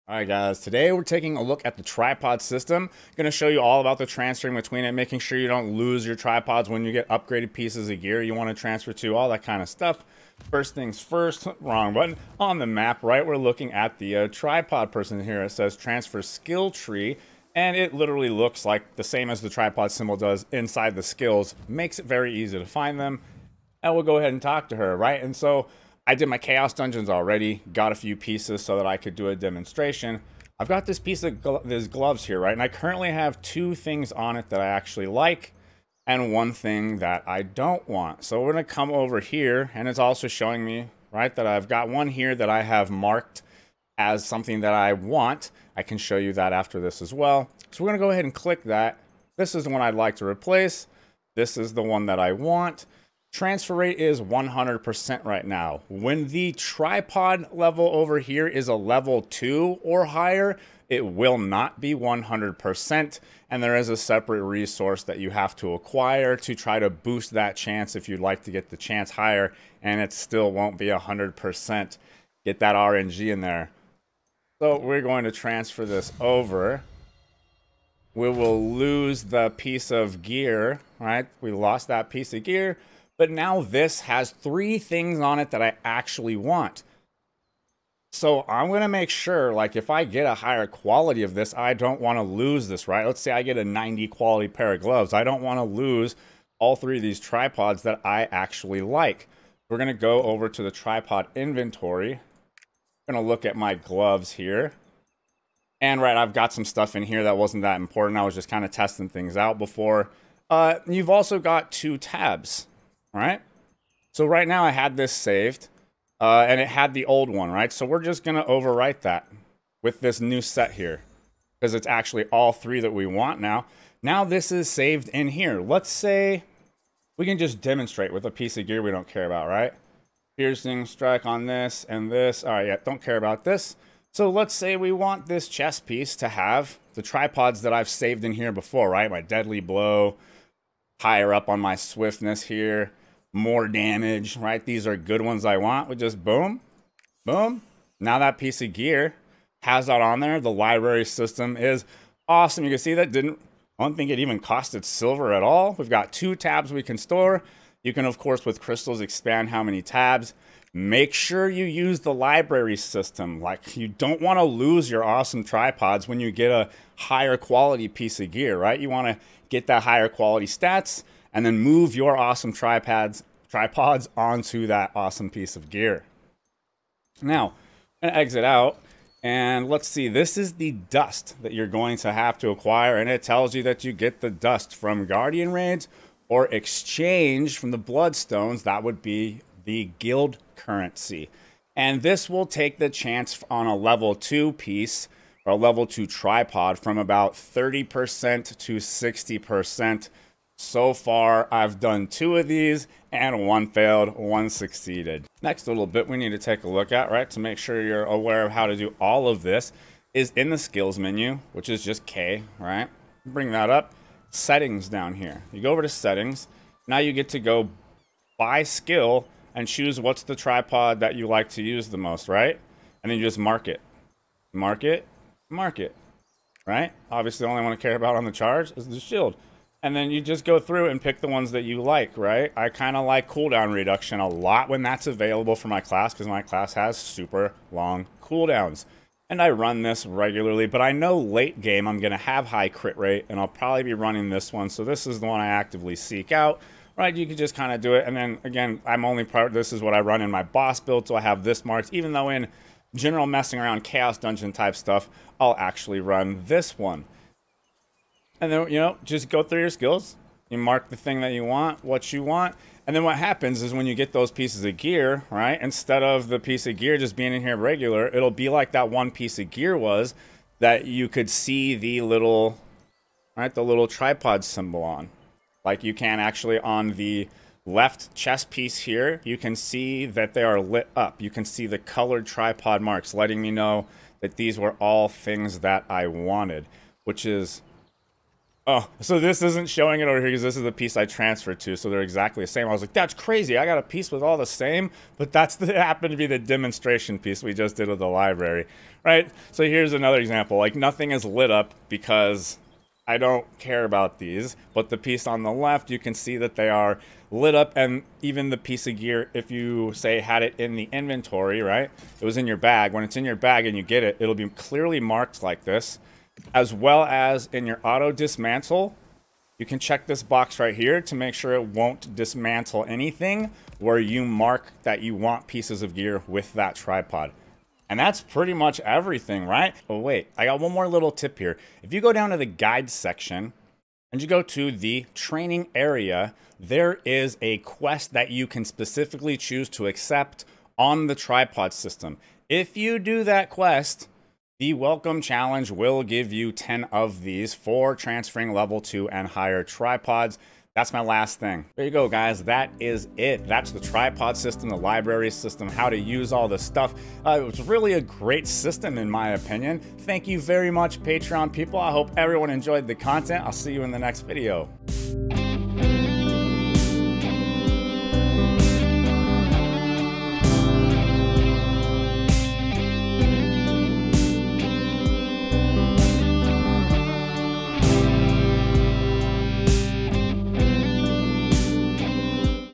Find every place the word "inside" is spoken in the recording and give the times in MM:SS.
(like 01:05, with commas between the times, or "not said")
00:20.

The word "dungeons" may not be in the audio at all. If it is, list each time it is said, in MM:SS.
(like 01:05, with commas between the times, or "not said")
00:26, 04:14.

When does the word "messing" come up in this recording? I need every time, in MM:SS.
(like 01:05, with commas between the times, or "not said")
04:13.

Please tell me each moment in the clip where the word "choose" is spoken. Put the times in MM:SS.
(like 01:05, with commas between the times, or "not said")
03:39, 05:39.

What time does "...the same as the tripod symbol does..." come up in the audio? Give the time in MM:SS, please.
00:18.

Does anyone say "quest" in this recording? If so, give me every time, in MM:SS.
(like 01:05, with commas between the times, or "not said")
05:37, 05:43.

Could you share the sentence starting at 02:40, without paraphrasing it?
Make sure you use the library system.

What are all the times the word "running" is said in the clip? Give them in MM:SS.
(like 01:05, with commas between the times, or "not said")
04:03.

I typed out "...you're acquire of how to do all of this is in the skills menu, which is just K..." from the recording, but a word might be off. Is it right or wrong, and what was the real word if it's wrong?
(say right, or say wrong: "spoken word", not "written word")
wrong: "aware", not "acquire".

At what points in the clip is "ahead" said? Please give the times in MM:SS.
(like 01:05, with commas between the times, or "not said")
00:24, 00:48.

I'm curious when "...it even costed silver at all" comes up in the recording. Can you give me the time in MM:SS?
02:34.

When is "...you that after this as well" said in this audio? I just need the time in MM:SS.
00:46.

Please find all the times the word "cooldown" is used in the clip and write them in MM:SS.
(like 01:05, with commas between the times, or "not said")
03:53, 03:58.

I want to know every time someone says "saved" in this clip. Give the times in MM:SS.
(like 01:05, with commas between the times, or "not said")
01:55, 02:04, 02:17.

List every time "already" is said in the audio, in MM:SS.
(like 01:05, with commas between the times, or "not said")
00:27.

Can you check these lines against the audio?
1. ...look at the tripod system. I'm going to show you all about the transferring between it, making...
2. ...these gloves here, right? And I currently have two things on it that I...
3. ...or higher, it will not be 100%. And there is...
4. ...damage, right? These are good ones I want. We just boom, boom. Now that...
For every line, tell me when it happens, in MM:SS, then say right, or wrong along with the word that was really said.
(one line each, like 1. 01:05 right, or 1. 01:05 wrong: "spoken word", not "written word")
1. 00:01 right
2. 00:31 right
3. 00:59 right
4. 02:23 right.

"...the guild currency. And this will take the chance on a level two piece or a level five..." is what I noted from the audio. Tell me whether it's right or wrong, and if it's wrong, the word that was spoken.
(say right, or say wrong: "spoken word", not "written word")
wrong: "two", not "five".